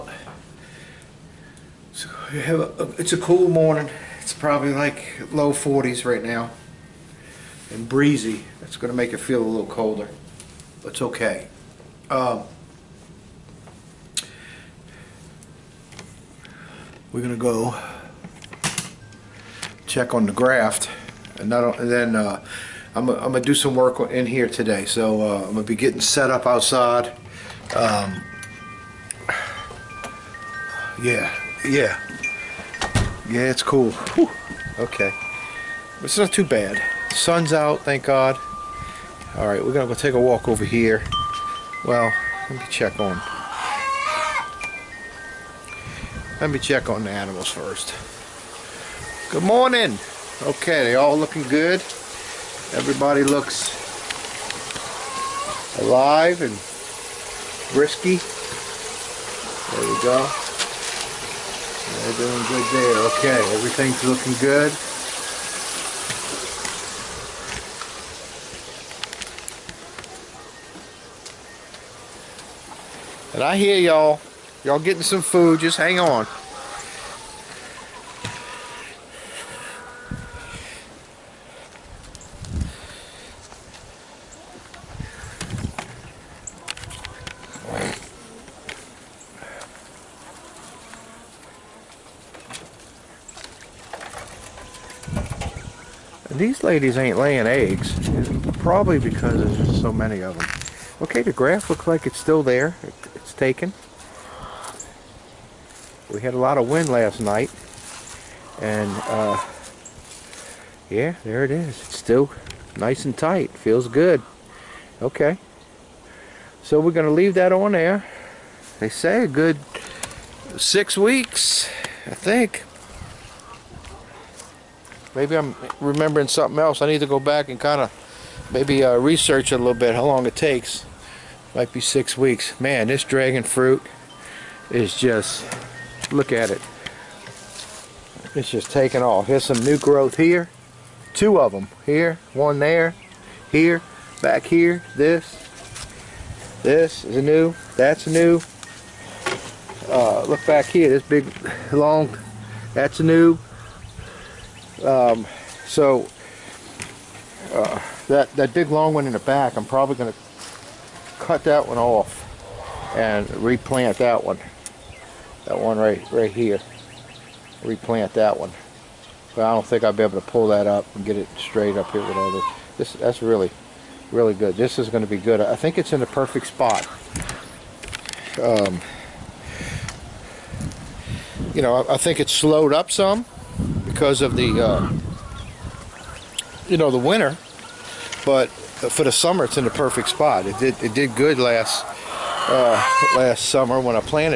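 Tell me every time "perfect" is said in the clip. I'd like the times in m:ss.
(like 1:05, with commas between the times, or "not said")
2:56, 3:09.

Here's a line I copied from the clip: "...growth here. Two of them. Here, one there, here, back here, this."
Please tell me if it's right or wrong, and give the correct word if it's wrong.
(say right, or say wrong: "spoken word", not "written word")
right.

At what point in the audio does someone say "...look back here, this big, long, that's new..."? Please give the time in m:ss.
2:30.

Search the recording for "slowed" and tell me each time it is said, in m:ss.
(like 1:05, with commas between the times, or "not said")
3:02.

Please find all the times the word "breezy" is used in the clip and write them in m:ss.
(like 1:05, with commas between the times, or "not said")
0:07.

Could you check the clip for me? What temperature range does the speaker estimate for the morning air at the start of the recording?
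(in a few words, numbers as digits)
low 40s.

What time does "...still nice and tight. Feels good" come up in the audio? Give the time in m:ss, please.
1:51.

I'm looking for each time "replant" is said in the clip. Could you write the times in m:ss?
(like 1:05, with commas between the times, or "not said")
2:43, 2:47.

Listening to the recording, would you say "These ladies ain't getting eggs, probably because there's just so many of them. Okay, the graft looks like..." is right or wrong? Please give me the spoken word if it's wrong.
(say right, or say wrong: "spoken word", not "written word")
wrong: "laying", not "getting".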